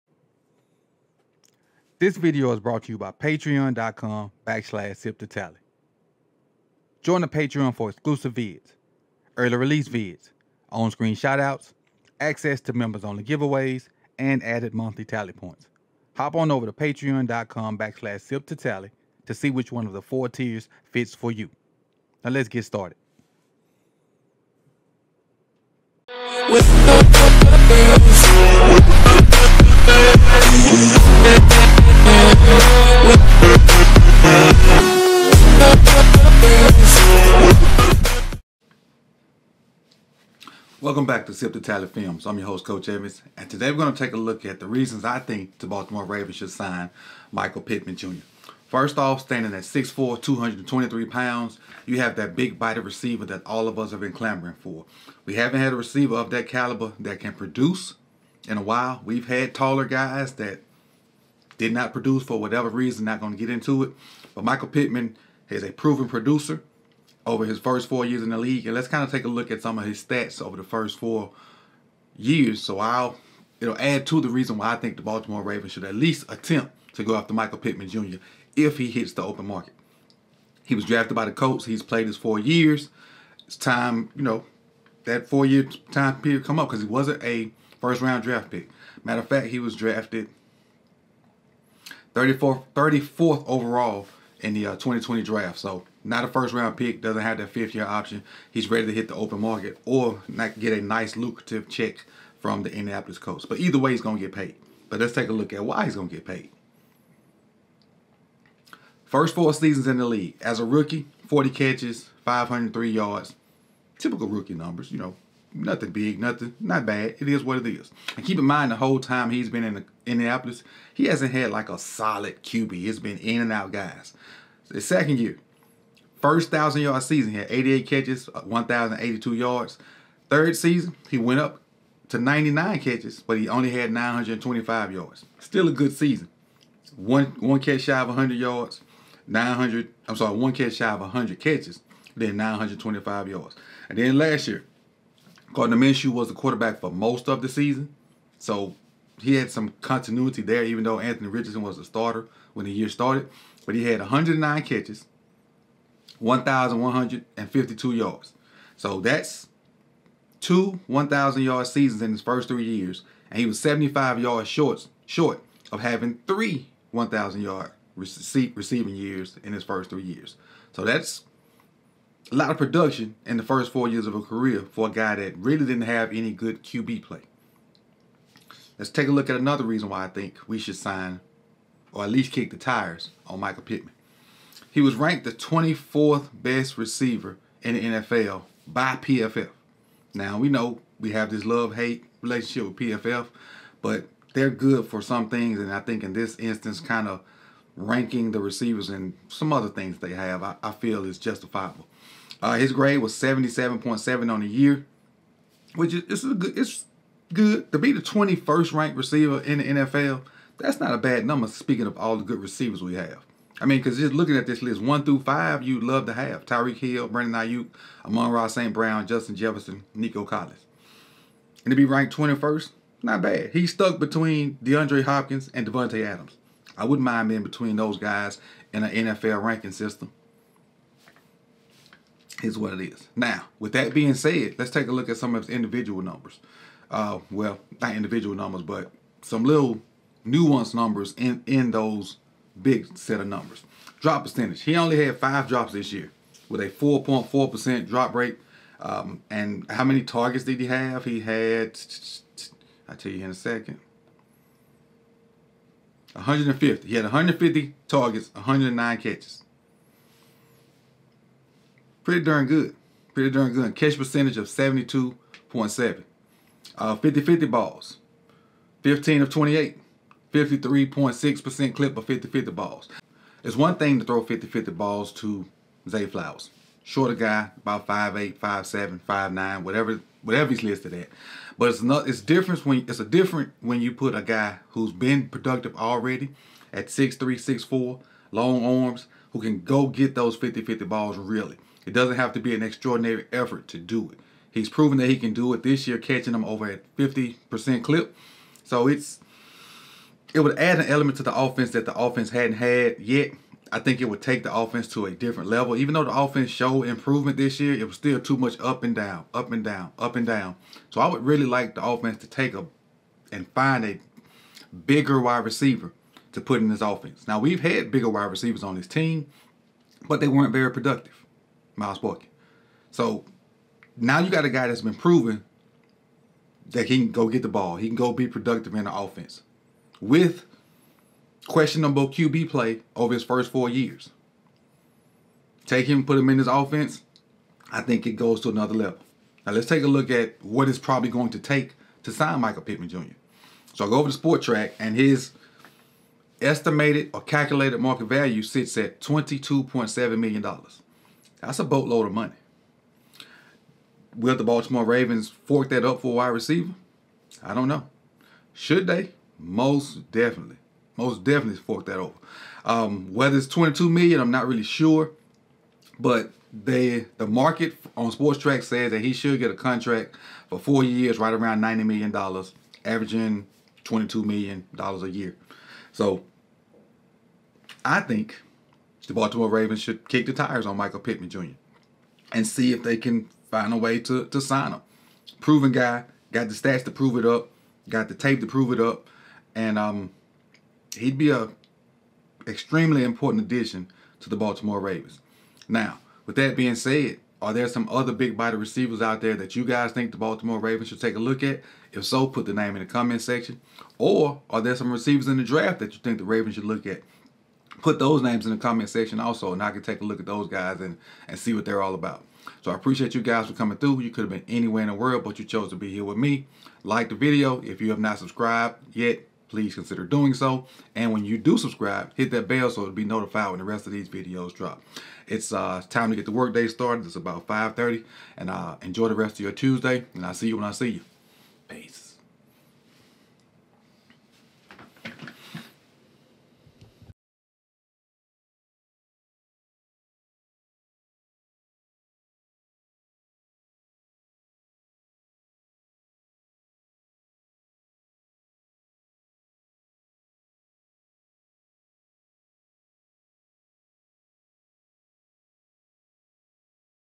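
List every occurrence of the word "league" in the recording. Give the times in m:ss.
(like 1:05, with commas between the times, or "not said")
1:08, 1:50.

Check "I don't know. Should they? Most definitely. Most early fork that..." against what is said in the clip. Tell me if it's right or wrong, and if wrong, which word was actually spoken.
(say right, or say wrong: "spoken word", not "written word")
wrong: "definitely", not "early".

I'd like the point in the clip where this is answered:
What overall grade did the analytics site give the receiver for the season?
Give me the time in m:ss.
3:23.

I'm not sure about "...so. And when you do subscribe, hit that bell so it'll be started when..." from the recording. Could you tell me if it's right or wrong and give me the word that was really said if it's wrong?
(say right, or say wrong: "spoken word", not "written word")
wrong: "notified", not "started".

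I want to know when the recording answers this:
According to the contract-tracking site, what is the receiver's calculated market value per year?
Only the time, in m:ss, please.
5:48.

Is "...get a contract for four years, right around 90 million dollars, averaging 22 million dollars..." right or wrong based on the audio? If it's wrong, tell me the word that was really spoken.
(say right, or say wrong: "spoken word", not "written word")
right.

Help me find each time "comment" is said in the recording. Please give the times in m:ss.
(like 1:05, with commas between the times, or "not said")
6:42, 6:48.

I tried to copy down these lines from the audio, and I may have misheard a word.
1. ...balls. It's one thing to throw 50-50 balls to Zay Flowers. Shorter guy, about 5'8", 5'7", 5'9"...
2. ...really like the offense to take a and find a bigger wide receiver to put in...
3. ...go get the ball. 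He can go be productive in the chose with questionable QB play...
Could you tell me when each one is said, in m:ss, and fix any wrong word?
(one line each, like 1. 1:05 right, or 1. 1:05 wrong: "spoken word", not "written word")
1. 4:32 right
2. 5:11 right
3. 5:27 wrong: "offense", not "chose".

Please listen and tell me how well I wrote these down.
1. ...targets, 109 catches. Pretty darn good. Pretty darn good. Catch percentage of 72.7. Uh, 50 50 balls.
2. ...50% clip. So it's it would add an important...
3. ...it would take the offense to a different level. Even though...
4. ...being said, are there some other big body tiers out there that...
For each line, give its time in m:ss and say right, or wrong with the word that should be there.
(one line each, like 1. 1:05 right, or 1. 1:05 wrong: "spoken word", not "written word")
1. 4:17 right
2. 4:56 wrong: "element", not "important"
3. 5:04 right
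4. 6:36 wrong: "receivers", not "tiers".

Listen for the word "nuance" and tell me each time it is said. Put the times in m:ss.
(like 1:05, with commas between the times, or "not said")
4:00.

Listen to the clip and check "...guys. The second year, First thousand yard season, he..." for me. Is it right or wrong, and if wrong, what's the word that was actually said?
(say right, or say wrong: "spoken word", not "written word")
right.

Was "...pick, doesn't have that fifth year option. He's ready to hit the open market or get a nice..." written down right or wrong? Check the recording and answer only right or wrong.
right.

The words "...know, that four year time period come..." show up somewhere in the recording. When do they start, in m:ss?
1:24.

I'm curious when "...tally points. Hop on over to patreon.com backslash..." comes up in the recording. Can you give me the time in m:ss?
0:15.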